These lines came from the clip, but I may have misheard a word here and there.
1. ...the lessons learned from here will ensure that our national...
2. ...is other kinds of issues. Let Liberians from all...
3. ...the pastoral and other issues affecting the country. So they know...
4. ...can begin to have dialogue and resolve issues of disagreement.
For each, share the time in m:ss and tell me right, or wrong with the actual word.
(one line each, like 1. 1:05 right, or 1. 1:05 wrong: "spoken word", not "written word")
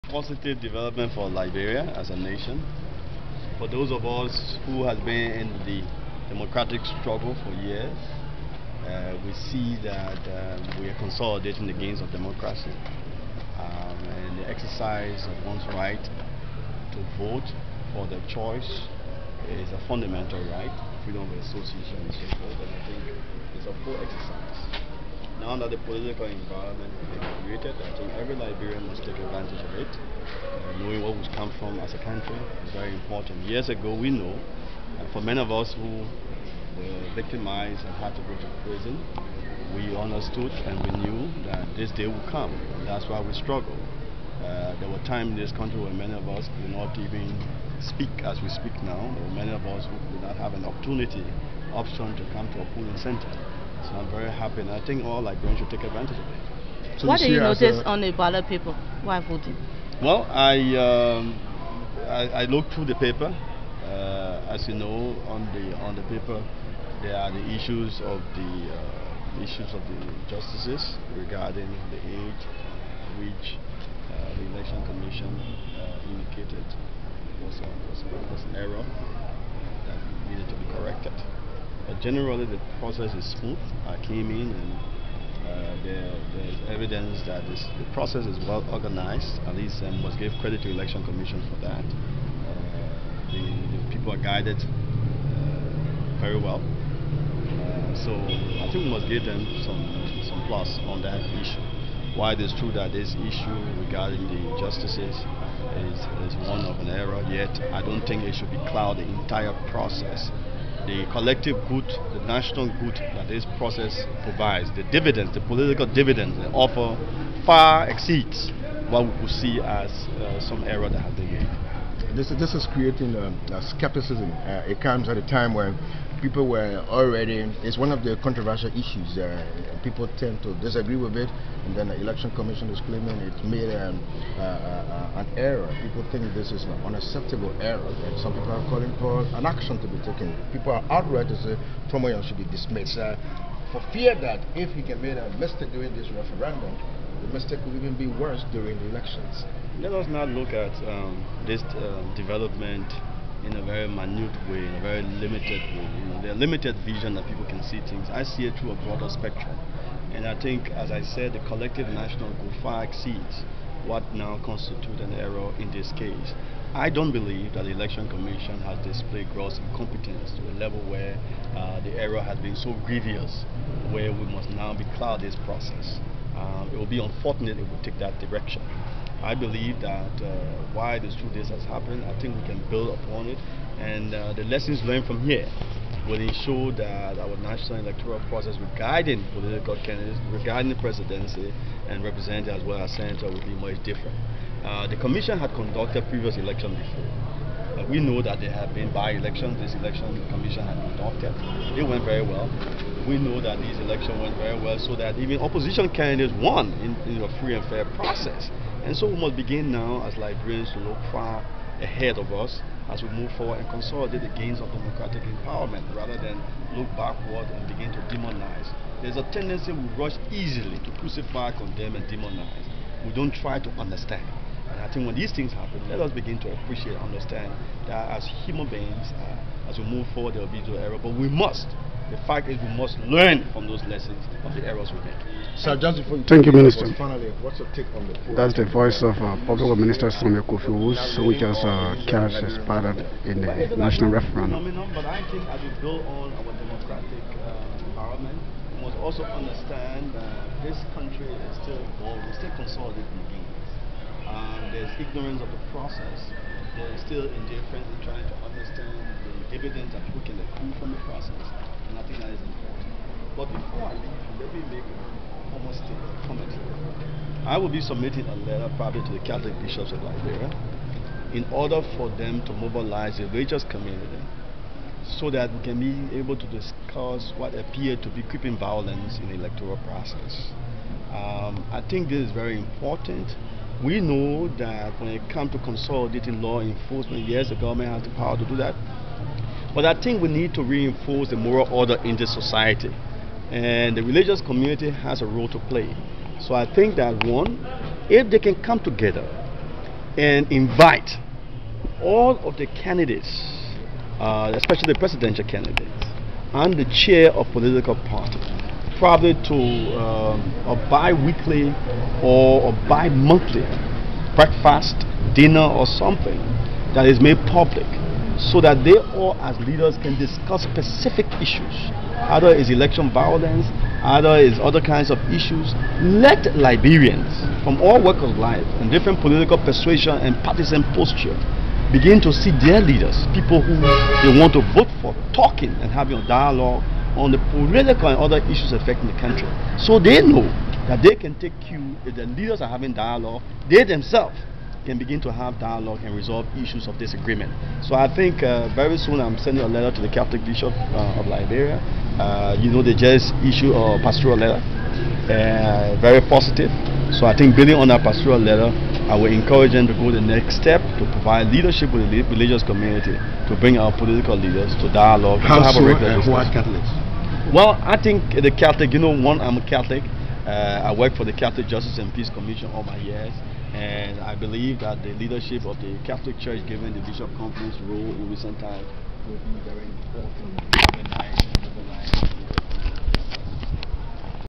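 1. 3:04 right
2. 5:24 right
3. 5:37 wrong: "political", not "pastoral"
4. 5:44 right.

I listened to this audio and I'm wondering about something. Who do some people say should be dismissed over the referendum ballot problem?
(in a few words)
Fromayan.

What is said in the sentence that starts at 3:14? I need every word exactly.
Uh, the commission had conducted previous elections before.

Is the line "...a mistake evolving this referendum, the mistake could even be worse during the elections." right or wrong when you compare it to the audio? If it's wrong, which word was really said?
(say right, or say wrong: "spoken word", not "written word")
wrong: "during", not "evolving".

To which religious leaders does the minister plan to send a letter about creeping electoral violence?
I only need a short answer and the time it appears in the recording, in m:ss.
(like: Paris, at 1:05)
Catholic bishops of Liberia, at 4:29.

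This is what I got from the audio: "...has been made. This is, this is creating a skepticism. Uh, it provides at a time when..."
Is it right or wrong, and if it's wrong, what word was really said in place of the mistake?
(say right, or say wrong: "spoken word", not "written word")
wrong: "comes", not "provides".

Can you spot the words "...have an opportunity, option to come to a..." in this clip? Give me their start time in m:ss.
0:50.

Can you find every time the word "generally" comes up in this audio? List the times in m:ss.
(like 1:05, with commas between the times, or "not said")
1:21.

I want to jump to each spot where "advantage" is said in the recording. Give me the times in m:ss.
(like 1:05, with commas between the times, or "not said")
0:29, 0:55.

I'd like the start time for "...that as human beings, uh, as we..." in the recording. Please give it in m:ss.
3:47.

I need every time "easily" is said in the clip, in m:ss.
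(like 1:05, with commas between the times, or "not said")
3:40.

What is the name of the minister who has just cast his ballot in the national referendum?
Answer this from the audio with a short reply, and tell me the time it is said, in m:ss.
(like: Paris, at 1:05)
Samuel Kofi, at 4:00.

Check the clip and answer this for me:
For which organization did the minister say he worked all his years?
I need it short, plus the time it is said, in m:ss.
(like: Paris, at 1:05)
Catholic Justice and Peace Commission, at 6:11.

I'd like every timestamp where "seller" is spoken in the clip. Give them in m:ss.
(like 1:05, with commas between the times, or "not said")
not said.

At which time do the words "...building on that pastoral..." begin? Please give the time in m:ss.
5:57.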